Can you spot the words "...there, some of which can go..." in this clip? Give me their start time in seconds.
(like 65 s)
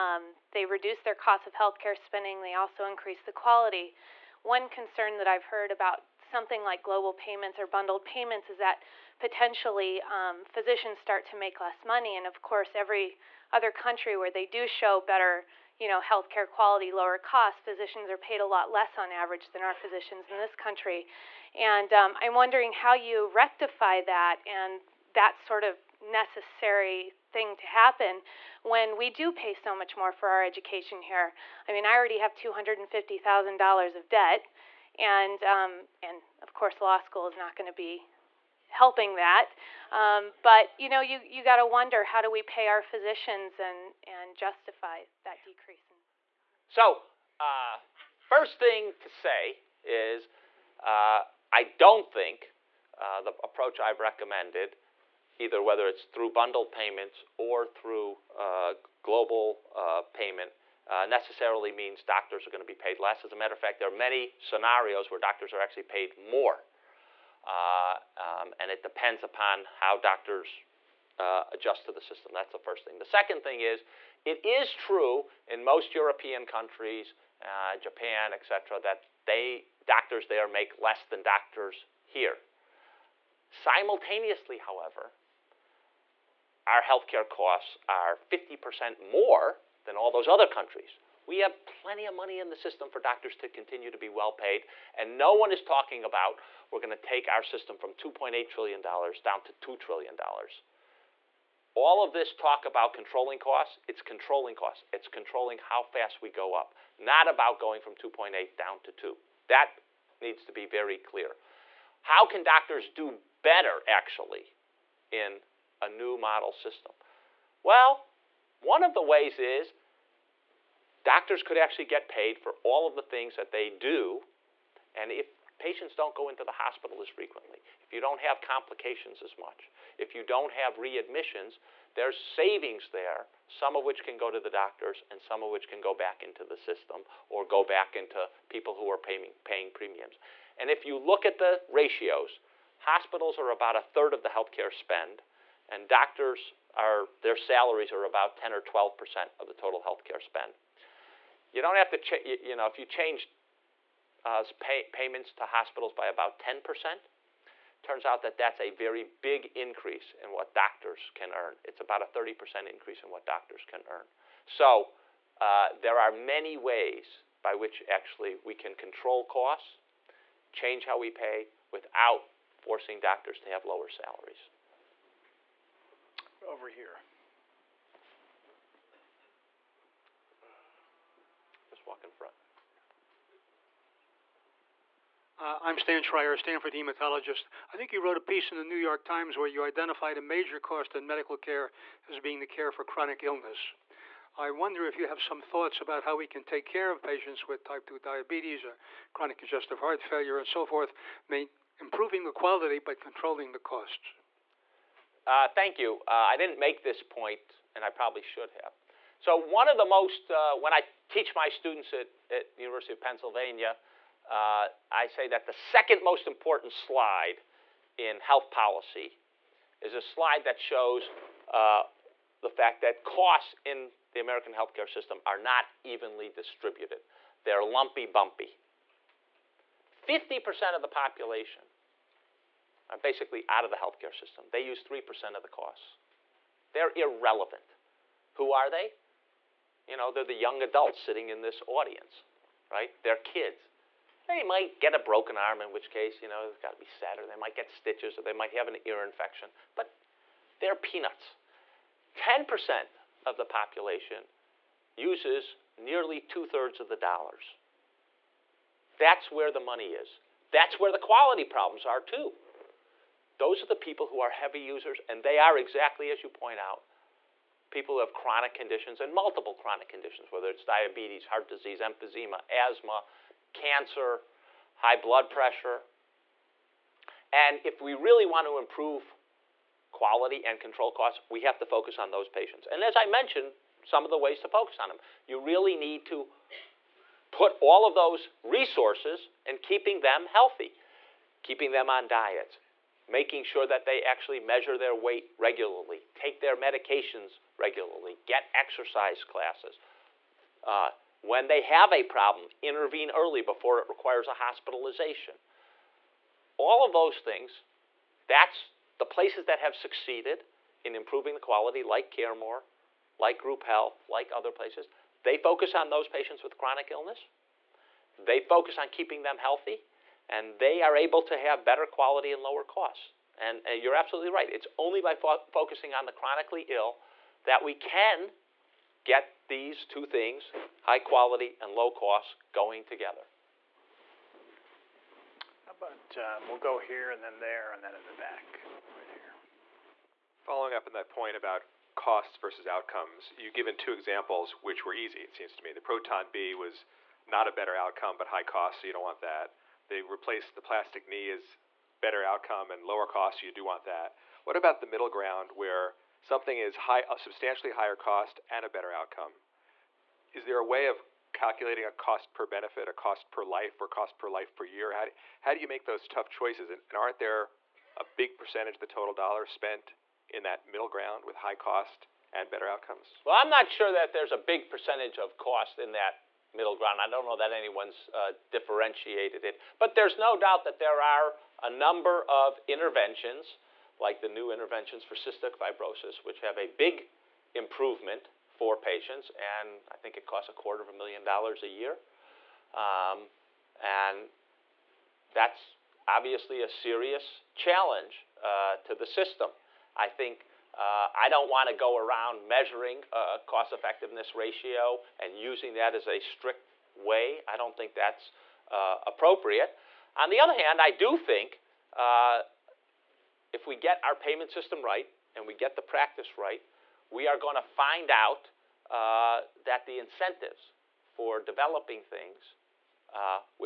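132 s.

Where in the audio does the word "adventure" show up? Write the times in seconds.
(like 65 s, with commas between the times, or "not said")
not said.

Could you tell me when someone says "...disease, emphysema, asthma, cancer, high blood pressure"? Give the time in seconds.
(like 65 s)
271 s.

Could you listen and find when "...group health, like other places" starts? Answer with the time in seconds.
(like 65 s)
313 s.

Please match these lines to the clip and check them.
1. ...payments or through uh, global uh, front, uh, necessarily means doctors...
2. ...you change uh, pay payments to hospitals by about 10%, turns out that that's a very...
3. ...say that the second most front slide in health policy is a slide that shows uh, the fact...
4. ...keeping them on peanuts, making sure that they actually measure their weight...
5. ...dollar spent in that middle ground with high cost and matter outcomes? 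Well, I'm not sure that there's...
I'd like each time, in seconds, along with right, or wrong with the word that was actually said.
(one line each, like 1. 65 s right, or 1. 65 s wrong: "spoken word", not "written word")
1. 56 s wrong: "payment", not "front"
2. 152 s right
3. 215 s wrong: "important", not "front"
4. 291 s wrong: "diets", not "peanuts"
5. 369 s wrong: "better", not "matter".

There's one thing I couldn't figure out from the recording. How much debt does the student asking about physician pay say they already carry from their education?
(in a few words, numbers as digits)
$250,000.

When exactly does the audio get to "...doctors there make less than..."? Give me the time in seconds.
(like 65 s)
79 s.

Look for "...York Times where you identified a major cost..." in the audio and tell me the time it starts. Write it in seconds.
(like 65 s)
188 s.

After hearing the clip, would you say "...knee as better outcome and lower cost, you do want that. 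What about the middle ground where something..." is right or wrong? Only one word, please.
right.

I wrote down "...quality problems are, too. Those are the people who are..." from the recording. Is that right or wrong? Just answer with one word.
right.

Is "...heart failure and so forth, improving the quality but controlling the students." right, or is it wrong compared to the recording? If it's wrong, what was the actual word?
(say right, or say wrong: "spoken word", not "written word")
wrong: "costs", not "students".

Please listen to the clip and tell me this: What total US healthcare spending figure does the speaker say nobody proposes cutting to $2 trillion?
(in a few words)
$2.8 trillion.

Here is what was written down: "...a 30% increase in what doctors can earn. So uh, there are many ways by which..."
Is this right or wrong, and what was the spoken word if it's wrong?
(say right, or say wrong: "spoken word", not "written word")
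right.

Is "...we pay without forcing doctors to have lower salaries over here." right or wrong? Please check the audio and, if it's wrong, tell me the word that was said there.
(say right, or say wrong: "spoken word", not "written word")
right.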